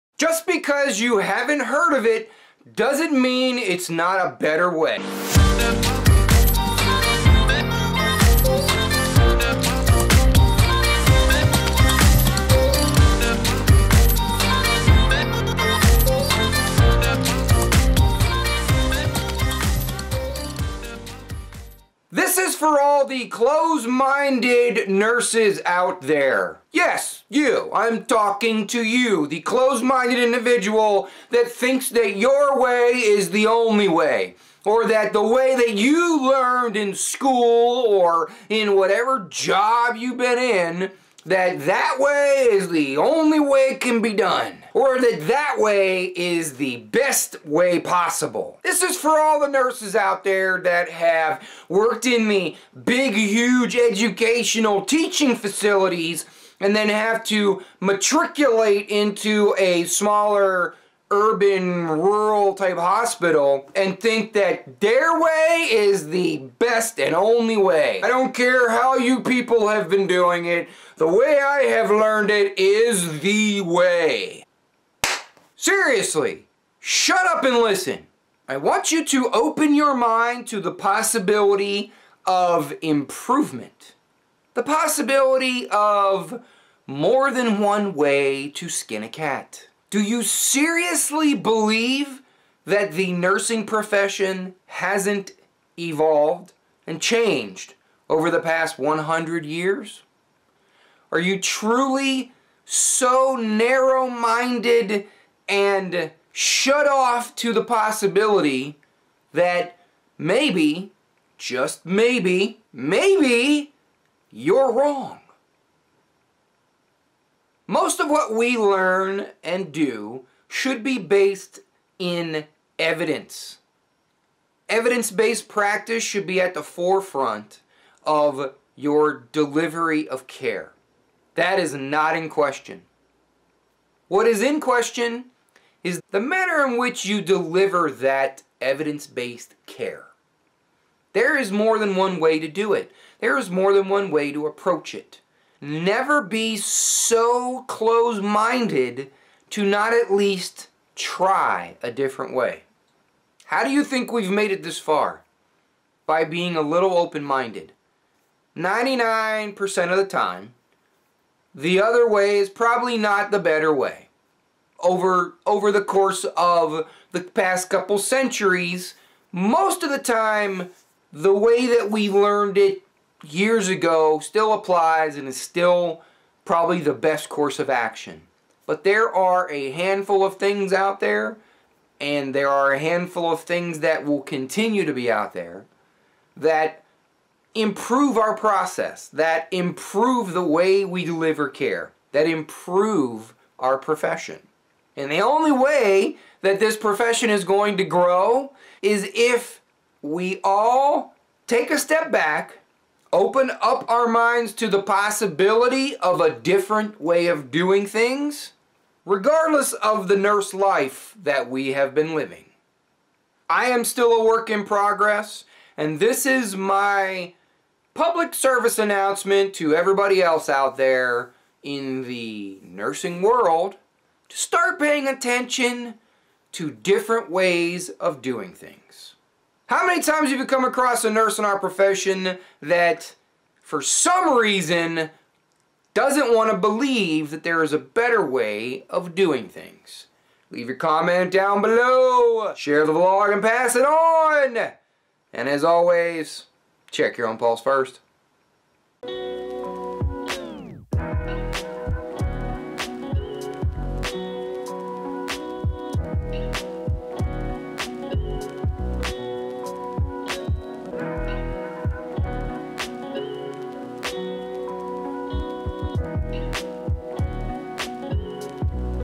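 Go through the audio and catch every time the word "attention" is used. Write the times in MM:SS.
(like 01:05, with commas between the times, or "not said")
03:45.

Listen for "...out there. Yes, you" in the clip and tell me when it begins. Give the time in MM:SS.
00:25.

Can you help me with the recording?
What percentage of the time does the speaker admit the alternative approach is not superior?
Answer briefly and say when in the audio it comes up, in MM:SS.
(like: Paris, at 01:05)
99%, at 02:38.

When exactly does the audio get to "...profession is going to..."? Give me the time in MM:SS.
03:16.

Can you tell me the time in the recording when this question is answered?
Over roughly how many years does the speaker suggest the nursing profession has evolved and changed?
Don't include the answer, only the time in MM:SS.
01:38.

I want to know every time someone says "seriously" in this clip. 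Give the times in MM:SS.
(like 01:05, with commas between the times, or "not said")
01:15, 01:30.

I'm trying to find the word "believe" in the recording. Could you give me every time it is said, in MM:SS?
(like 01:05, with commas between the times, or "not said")
01:31, 03:56.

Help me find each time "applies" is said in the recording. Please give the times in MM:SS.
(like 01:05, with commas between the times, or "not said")
02:54.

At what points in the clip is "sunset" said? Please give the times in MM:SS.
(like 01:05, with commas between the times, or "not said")
not said.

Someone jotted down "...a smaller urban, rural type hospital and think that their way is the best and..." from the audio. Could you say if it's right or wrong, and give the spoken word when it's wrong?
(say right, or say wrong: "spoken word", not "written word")
right.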